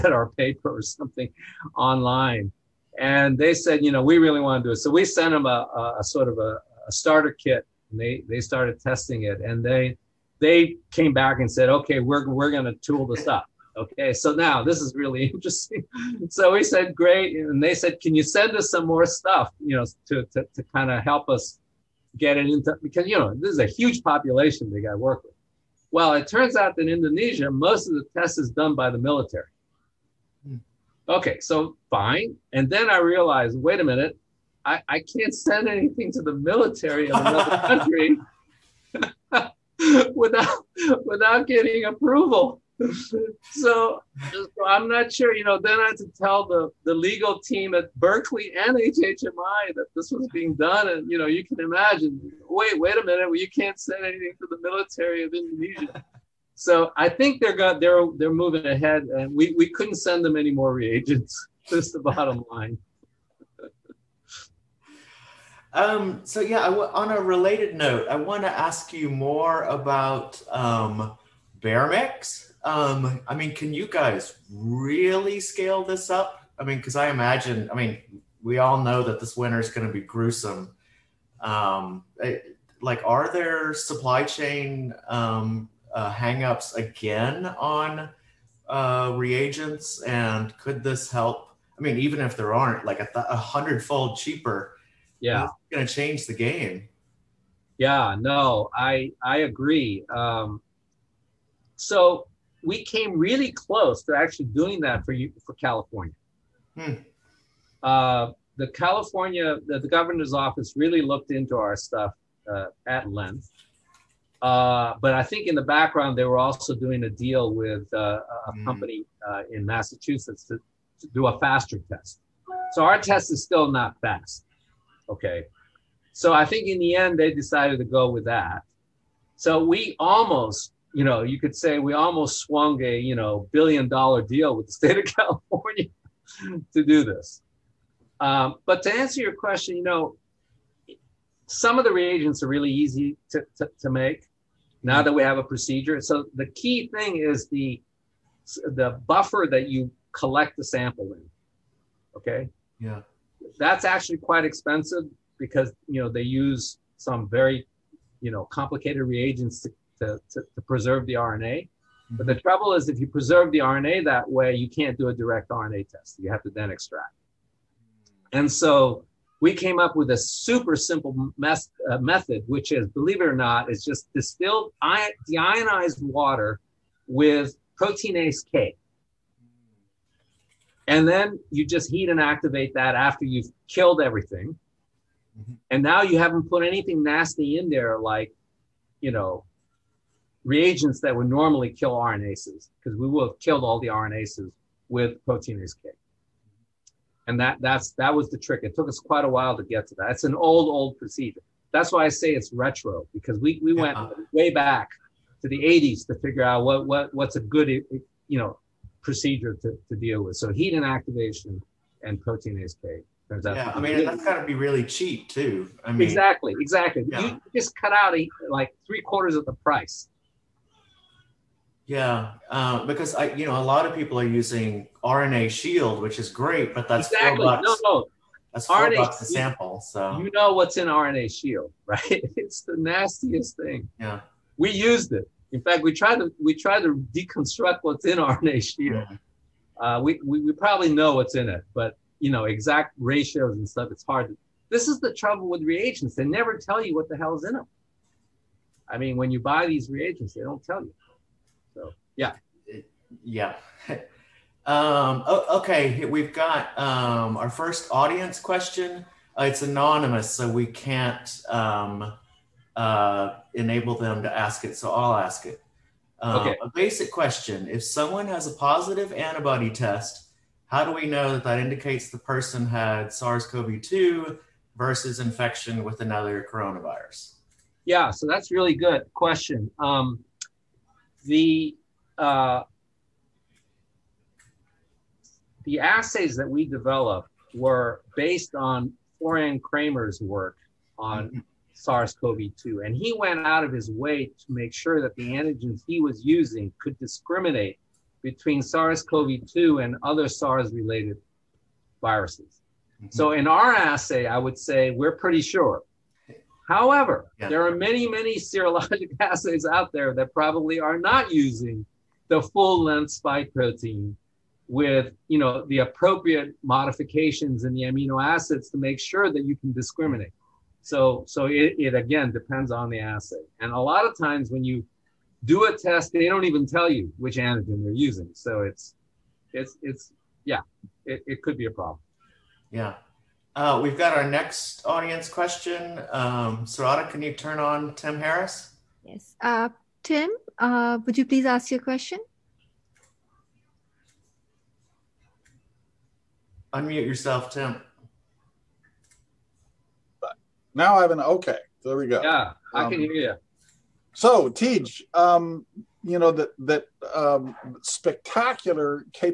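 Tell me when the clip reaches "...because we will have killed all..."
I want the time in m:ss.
3:12.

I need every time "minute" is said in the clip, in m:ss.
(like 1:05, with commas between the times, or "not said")
0:33, 0:53.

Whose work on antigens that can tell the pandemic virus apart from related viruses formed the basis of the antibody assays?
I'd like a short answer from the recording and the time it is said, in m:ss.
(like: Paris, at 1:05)
Florian Kramer, at 4:49.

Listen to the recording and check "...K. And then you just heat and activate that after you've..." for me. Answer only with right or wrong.
right.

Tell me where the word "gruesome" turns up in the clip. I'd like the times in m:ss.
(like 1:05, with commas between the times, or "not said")
1:19.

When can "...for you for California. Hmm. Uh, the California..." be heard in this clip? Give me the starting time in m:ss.
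1:45.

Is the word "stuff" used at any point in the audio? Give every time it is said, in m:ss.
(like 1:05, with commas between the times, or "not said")
0:19, 1:51, 4:03.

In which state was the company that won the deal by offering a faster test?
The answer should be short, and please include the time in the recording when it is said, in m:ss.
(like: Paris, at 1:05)
Massachusetts, at 1:59.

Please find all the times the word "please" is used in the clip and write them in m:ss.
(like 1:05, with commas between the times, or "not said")
5:41.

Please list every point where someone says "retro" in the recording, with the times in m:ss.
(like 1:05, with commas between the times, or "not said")
3:22.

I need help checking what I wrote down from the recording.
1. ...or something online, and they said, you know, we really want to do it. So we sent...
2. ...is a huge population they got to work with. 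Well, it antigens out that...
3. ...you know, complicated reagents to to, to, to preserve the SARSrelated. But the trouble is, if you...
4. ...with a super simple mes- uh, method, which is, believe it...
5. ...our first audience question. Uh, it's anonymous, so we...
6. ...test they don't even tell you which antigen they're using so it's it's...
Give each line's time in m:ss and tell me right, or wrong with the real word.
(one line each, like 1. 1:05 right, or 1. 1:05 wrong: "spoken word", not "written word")
1. 0:00 right
2. 0:23 wrong: "turns", not "antigens"
3. 2:38 wrong: "RNA", not "SARSrelated"
4. 2:49 right
5. 4:17 right
6. 5:25 right.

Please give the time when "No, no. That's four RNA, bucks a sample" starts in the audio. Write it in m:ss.
3:47.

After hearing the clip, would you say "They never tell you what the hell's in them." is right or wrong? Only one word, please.
right.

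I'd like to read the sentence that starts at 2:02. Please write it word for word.
So our test is still not fast.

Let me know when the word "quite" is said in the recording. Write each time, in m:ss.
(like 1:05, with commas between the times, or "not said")
2:34, 3:18.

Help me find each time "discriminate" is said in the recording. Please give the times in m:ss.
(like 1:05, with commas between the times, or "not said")
4:56, 5:19.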